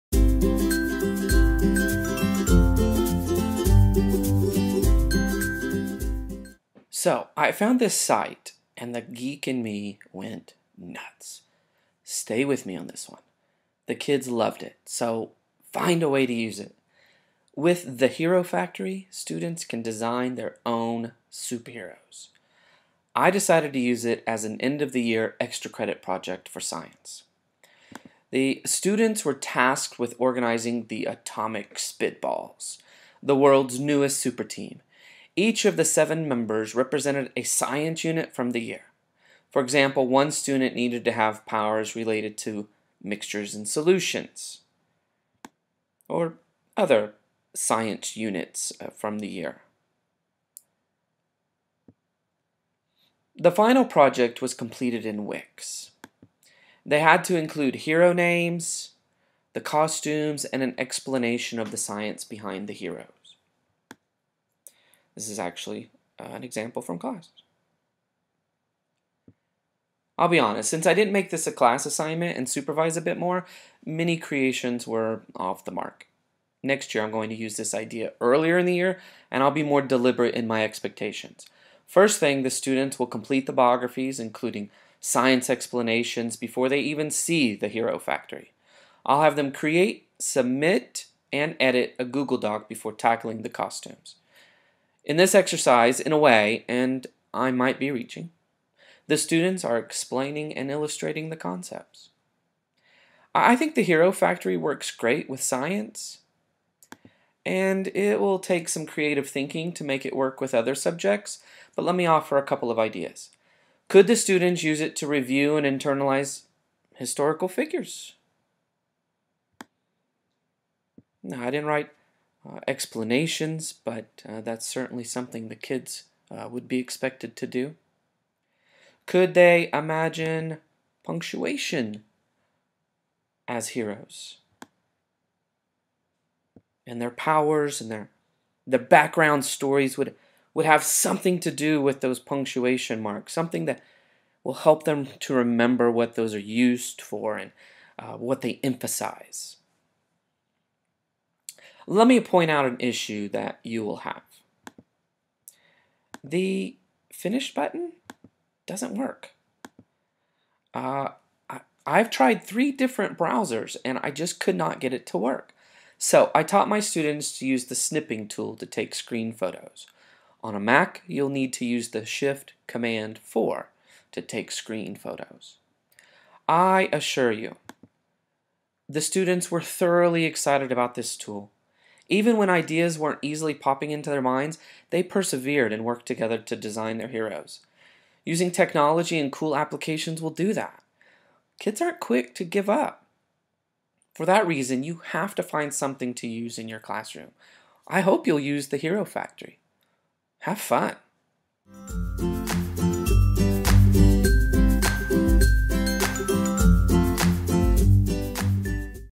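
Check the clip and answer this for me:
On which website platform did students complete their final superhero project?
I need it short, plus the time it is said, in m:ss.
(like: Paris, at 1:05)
Wix, at 0:55.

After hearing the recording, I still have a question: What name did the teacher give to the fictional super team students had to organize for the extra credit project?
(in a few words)
Atomic Spitballs.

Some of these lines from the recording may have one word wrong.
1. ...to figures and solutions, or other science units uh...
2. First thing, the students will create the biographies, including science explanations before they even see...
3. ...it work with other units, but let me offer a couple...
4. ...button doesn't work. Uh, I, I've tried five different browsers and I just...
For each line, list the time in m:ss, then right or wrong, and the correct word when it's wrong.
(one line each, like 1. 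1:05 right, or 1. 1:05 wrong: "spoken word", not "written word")
1. 0:42 wrong: "mixtures", not "figures"
2. 1:21 wrong: "complete", not "create"
3. 1:50 wrong: "subjects", not "units"
4. 2:37 wrong: "three", not "five".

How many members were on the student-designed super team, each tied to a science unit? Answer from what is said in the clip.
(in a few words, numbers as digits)
7.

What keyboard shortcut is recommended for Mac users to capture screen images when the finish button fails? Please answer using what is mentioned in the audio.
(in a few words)
Shift Command 4.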